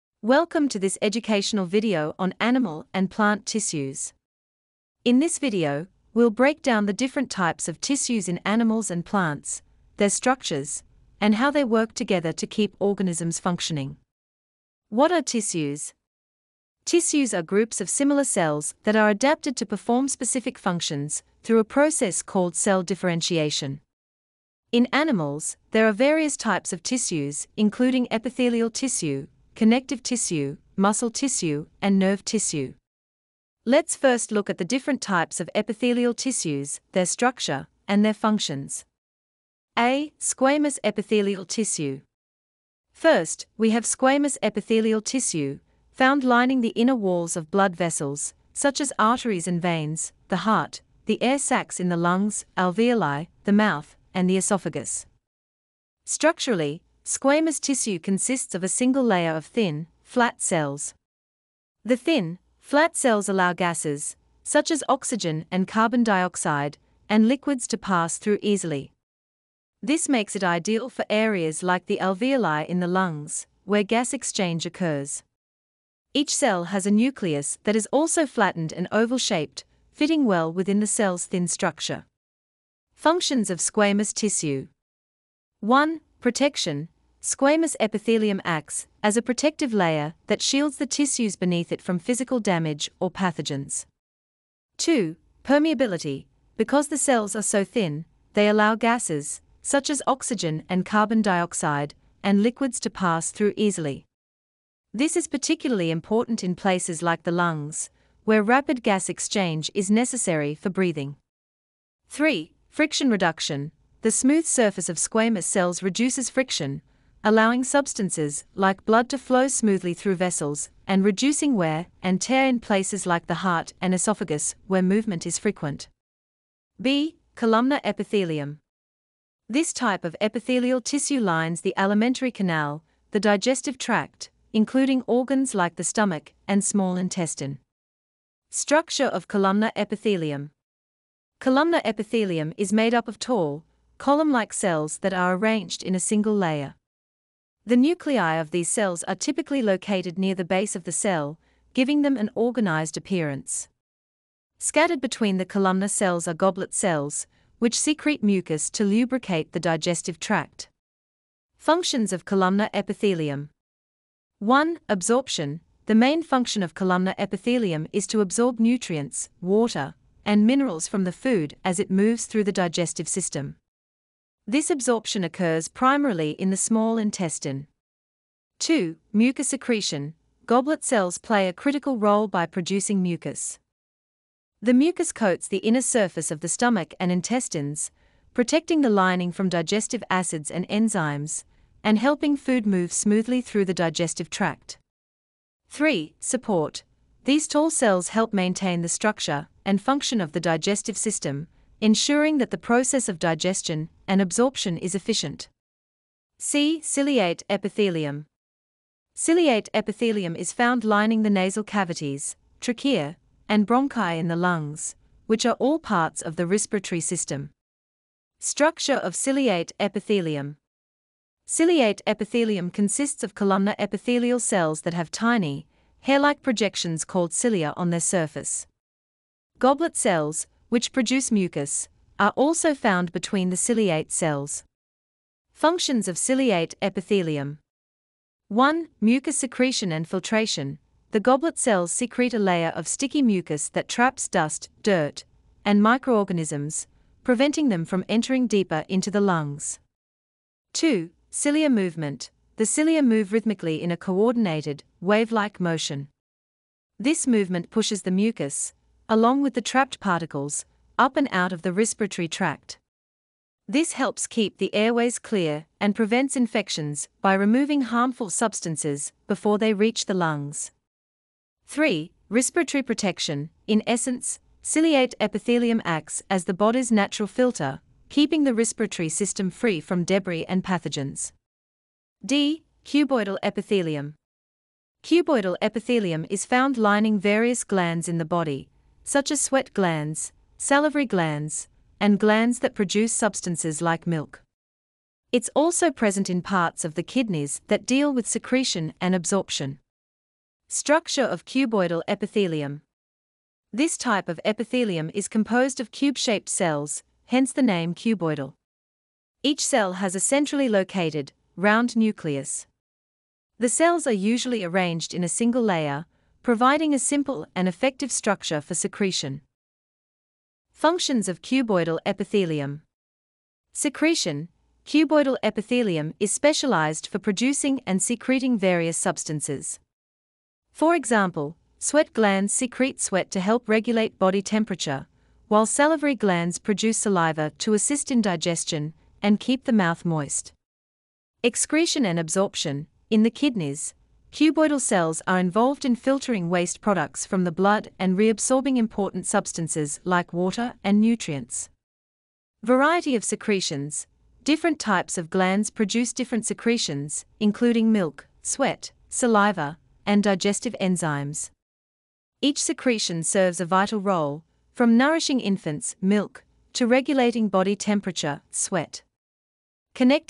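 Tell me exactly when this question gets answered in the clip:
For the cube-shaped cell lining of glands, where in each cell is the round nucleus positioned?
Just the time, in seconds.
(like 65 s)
310 s.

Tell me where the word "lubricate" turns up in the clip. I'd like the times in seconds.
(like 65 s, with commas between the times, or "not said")
158 s.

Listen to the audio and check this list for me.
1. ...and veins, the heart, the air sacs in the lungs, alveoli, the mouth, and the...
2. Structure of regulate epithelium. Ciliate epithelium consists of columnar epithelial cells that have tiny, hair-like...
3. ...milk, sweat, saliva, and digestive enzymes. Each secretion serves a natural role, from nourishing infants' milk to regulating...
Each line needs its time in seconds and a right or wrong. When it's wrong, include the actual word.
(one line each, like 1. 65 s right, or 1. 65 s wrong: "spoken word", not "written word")
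1. 49 s right
2. 218 s wrong: "ciliate", not "regulate"
3. 357 s wrong: "vital", not "natural".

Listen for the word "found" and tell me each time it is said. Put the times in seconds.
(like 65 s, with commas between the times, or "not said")
45 s, 210 s, 232 s, 286 s.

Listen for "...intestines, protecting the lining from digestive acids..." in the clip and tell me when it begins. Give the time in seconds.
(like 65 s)
187 s.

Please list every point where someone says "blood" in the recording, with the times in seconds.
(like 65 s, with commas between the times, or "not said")
47 s, 118 s, 347 s.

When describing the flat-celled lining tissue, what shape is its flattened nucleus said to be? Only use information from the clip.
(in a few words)
oval shaped.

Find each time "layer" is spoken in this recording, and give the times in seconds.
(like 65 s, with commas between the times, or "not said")
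59 s, 89 s, 146 s, 242 s, 315 s.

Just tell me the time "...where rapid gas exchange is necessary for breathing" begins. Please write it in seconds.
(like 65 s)
108 s.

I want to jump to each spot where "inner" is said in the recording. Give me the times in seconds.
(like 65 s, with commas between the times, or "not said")
46 s, 185 s.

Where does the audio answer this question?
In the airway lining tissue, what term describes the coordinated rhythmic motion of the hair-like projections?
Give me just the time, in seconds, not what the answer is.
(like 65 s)
254 s.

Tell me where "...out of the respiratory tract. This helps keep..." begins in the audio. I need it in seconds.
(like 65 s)
261 s.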